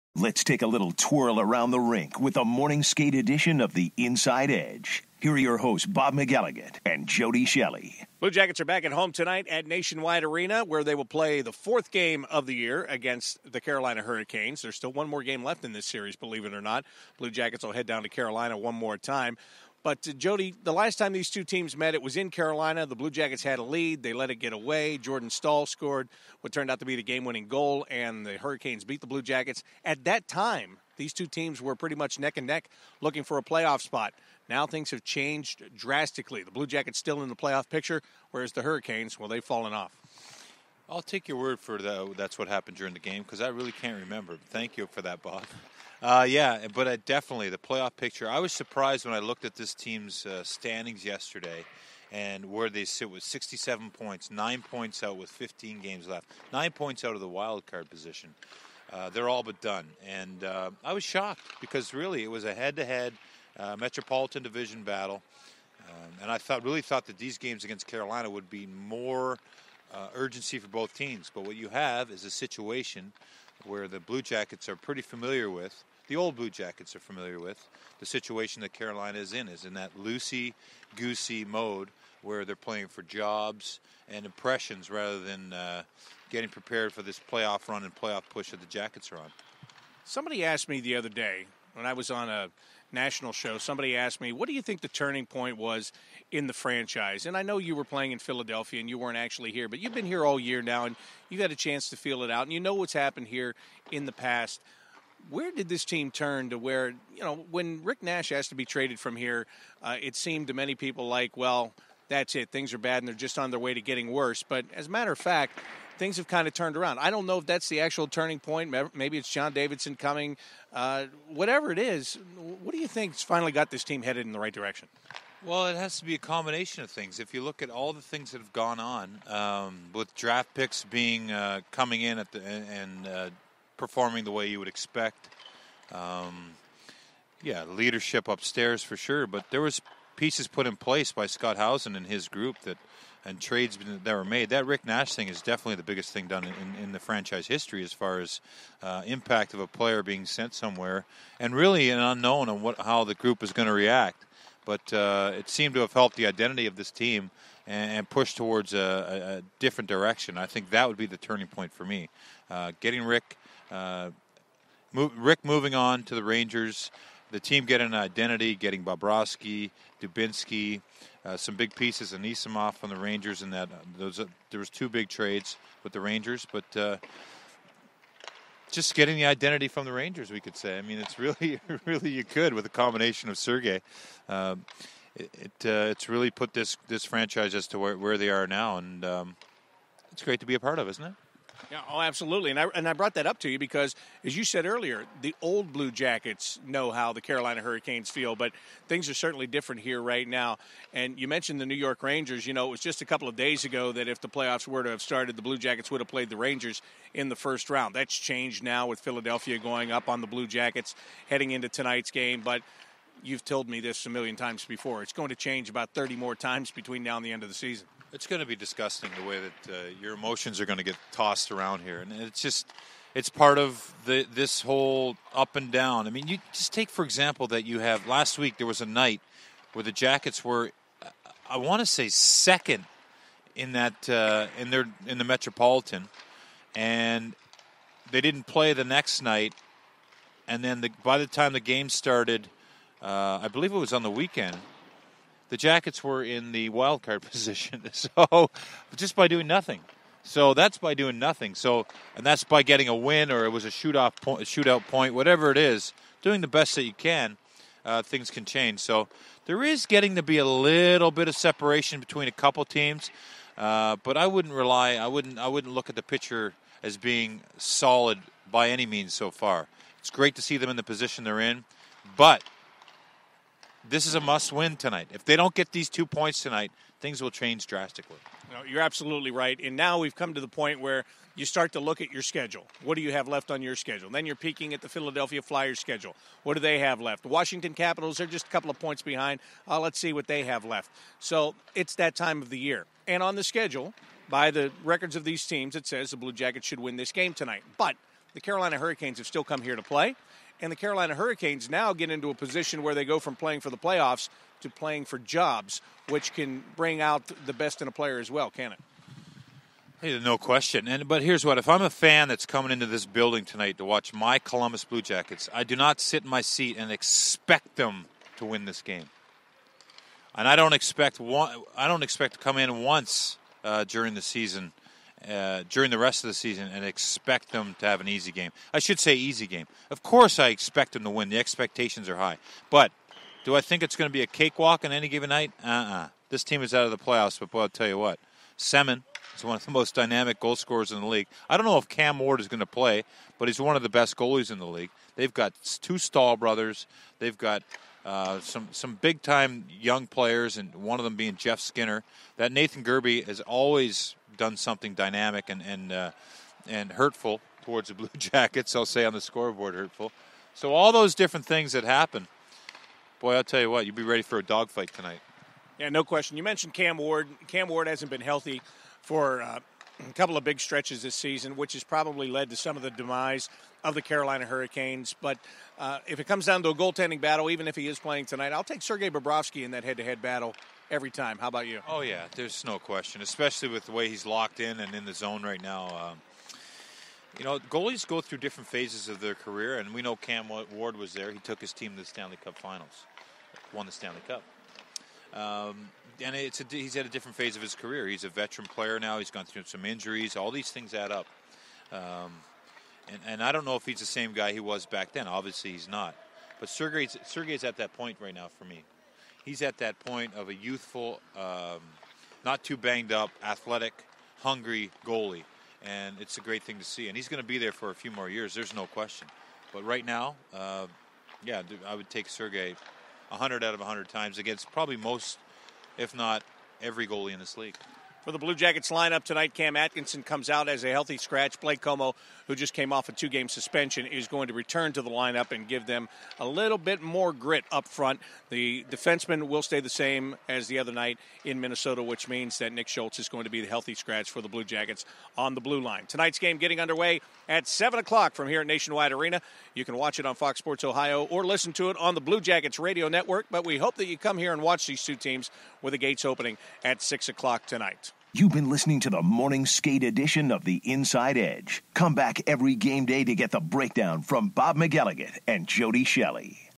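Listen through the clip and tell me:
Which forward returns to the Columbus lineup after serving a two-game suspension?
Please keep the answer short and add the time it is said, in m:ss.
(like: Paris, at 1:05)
Blake Comeau, at 7:11.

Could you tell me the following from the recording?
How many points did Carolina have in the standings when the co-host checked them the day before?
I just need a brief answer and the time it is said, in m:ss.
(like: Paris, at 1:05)
67, at 0:53.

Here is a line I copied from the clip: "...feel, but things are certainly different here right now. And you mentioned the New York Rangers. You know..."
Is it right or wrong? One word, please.
right.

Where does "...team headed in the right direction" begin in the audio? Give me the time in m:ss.
2:03.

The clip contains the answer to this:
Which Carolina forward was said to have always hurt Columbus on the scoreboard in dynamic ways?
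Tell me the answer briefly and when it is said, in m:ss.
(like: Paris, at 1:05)
Nathan Gerbe, at 5:52.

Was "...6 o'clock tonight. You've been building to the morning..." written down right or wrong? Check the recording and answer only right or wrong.
wrong.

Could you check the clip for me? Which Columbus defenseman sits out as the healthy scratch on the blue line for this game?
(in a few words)
Nick Schultz.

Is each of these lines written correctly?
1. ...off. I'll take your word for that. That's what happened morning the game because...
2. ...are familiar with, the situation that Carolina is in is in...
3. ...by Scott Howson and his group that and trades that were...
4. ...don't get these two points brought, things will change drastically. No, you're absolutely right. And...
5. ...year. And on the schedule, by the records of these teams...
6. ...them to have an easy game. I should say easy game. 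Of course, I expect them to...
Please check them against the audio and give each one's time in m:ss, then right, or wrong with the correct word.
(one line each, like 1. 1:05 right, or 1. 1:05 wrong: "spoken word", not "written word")
1. 0:39 wrong: "during", not "morning"
2. 1:16 right
3. 2:21 right
4. 4:35 wrong: "tonight", not "brought"
5. 4:52 right
6. 5:27 right.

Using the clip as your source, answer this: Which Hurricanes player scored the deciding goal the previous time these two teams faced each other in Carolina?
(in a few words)
Jordan Staal.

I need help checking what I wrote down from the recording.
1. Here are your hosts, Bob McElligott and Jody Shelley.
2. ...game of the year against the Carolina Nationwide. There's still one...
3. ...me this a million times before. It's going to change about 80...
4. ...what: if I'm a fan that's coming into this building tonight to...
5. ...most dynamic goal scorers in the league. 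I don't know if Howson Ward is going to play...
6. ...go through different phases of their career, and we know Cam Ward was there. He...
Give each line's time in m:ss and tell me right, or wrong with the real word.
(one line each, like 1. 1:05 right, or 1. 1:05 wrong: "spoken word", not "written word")
1. 0:05 right
2. 0:11 wrong: "Hurricanes", not "Nationwide"
3. 3:33 wrong: "30", not "80"
4. 5:11 right
5. 5:39 wrong: "Cam", not "Howson"
6. 6:28 right.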